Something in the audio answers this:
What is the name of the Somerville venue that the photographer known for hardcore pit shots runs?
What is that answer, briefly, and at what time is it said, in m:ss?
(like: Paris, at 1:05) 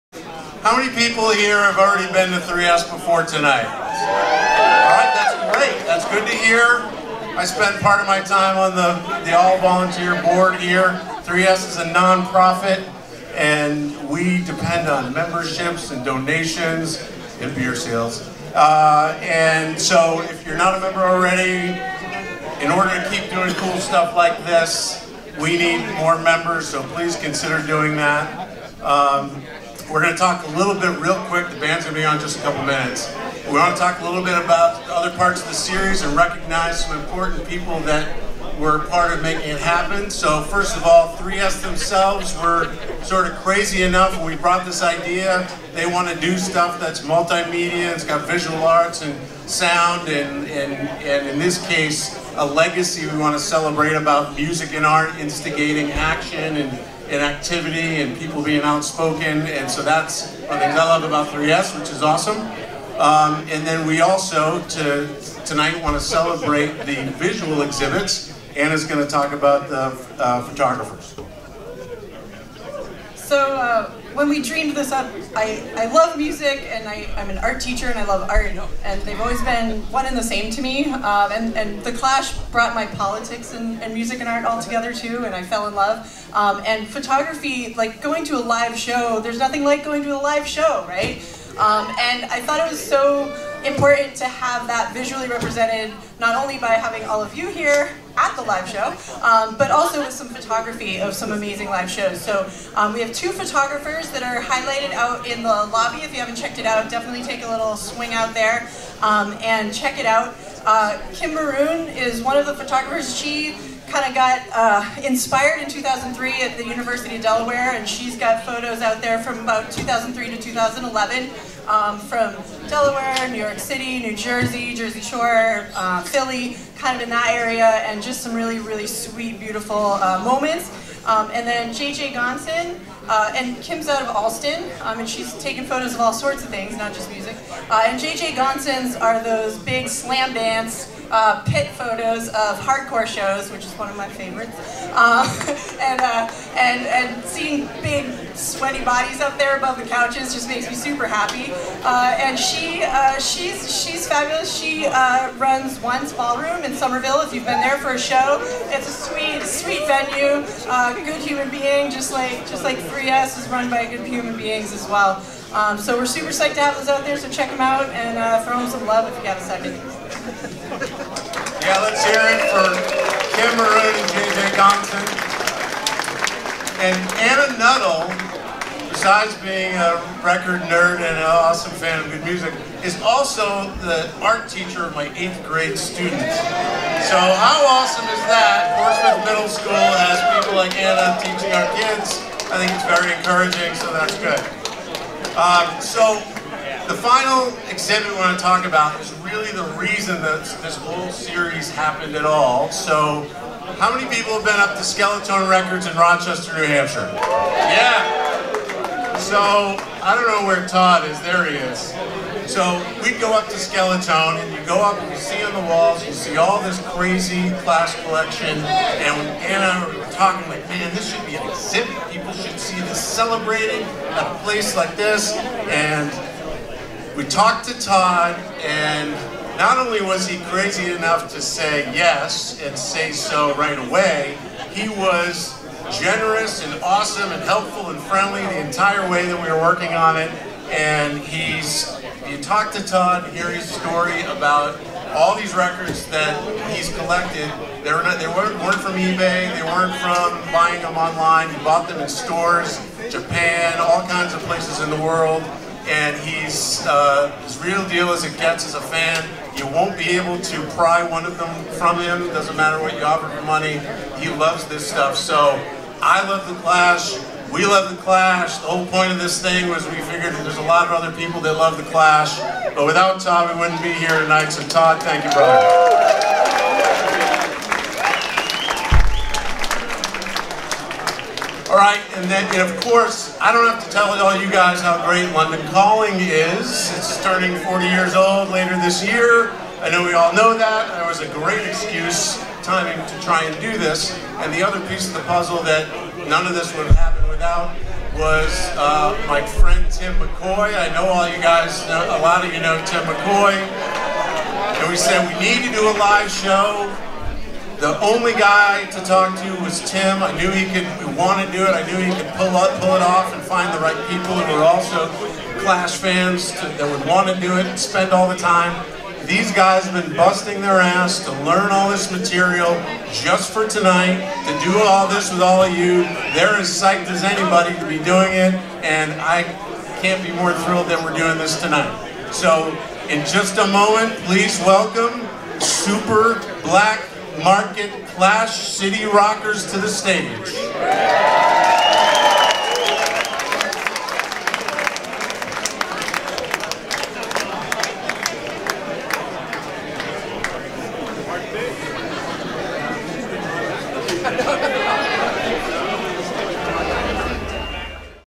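ONCE Ballroom, at 2:35.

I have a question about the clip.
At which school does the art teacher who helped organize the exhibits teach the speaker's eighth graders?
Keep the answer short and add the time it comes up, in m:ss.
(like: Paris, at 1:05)
Portsmouth Middle School, at 3:08.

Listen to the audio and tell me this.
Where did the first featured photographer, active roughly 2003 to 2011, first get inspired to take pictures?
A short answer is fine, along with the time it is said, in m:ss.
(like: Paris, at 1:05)
University of Delaware, at 1:56.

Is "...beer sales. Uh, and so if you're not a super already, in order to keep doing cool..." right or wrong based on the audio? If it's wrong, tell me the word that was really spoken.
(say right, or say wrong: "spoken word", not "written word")
wrong: "member", not "super".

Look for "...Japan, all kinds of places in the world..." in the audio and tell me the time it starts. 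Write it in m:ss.
4:13.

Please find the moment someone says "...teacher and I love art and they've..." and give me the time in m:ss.
1:17.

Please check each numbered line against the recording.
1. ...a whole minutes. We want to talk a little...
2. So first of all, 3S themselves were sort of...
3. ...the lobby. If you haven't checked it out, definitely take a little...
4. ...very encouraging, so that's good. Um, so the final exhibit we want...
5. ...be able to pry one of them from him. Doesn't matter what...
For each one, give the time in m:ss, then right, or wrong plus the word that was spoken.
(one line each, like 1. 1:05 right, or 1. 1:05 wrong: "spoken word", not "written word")
1. 0:32 wrong: "couple", not "whole"
2. 0:40 right
3. 1:45 right
4. 3:12 right
5. 4:19 right.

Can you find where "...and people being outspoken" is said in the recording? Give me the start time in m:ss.
0:58.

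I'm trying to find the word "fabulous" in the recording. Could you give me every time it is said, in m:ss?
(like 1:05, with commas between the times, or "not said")
2:34.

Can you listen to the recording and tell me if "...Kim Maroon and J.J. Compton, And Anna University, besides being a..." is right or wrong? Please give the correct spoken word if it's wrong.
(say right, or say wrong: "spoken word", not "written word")
wrong: "Nuttall", not "University".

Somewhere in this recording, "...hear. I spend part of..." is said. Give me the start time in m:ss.
0:06.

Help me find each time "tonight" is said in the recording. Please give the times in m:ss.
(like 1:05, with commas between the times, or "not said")
0:03, 1:05, 4:34, 5:23, 5:31.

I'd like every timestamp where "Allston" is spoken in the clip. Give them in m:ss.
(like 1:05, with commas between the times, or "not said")
2:14.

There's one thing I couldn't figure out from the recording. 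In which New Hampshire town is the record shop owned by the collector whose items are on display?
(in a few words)
Rochester.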